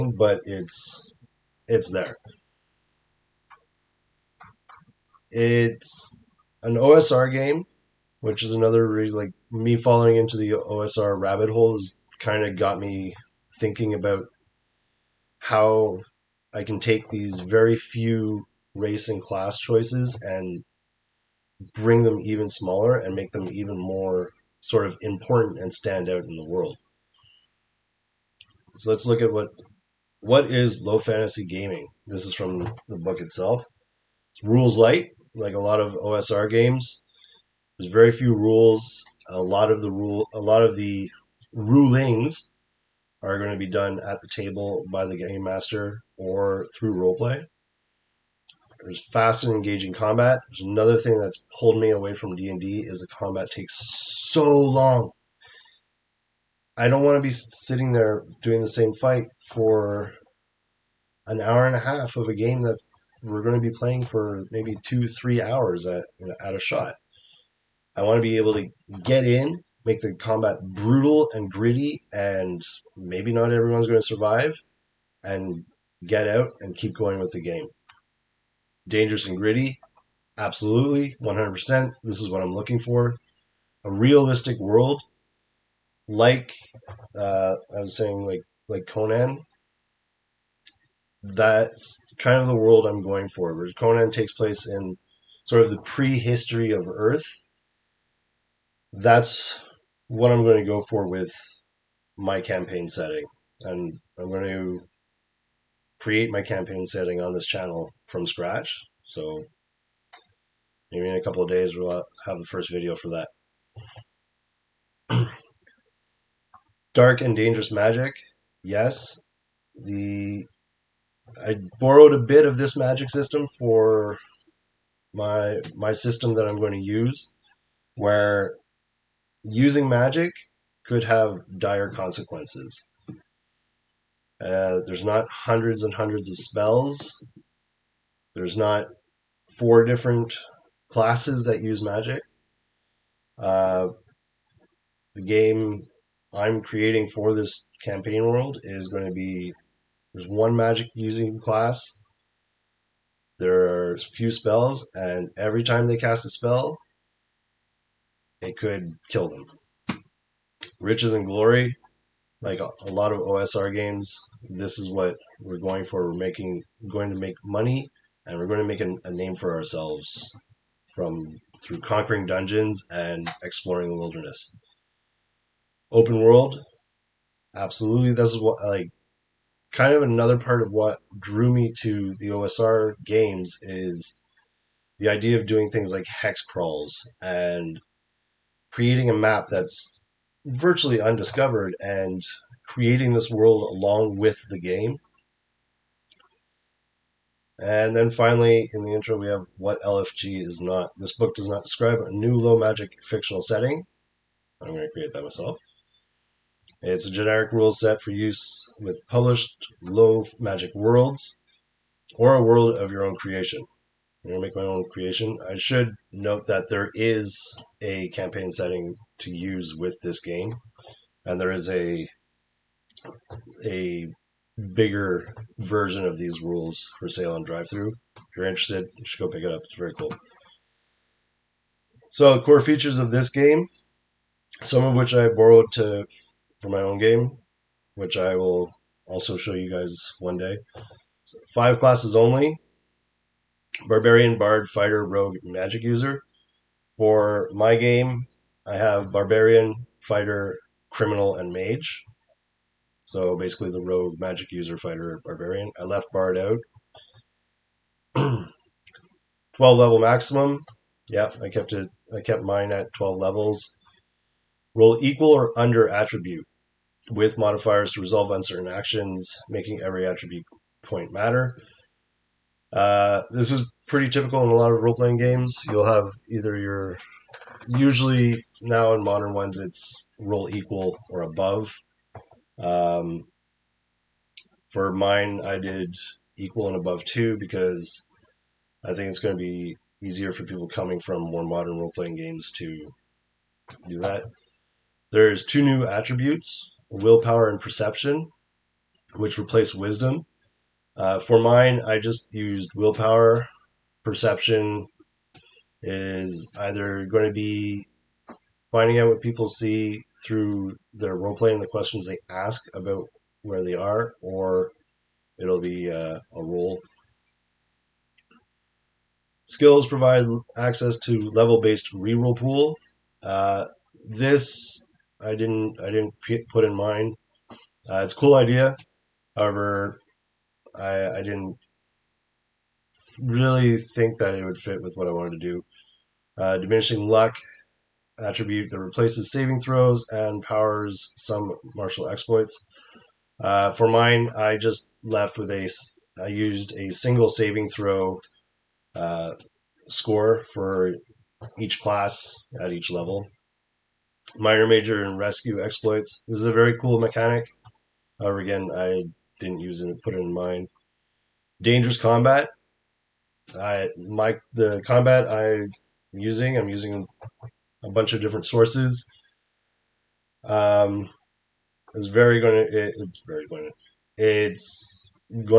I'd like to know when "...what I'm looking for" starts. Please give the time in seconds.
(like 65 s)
82 s.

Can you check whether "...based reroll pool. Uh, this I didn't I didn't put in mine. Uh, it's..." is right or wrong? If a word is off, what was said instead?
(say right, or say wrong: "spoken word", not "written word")
right.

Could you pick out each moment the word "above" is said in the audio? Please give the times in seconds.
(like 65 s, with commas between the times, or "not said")
281 s, 286 s.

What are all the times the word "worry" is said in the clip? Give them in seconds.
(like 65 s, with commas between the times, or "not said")
not said.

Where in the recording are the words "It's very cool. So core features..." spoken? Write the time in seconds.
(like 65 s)
229 s.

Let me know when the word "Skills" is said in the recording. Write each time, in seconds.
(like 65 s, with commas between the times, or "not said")
319 s.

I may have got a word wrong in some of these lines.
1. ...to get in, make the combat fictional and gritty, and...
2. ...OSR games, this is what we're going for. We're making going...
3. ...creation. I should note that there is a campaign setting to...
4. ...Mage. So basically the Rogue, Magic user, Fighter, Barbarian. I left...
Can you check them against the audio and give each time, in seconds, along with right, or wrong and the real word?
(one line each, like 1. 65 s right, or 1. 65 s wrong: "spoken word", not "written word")
1. 68 s wrong: "brutal", not "fictional"
2. 163 s right
3. 214 s right
4. 251 s right.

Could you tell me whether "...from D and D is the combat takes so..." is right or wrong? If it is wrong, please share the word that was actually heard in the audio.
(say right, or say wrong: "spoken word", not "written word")
right.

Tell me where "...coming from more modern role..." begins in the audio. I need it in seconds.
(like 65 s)
290 s.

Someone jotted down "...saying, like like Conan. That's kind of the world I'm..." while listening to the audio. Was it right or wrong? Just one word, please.
right.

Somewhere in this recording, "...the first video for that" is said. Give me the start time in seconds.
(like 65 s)
112 s.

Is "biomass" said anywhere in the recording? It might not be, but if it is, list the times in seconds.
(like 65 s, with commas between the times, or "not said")
not said.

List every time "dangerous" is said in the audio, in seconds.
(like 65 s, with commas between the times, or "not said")
78 s, 117 s, 361 s.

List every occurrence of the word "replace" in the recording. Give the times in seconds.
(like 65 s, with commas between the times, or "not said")
299 s, 338 s.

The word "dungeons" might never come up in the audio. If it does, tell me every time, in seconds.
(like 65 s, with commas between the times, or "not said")
172 s.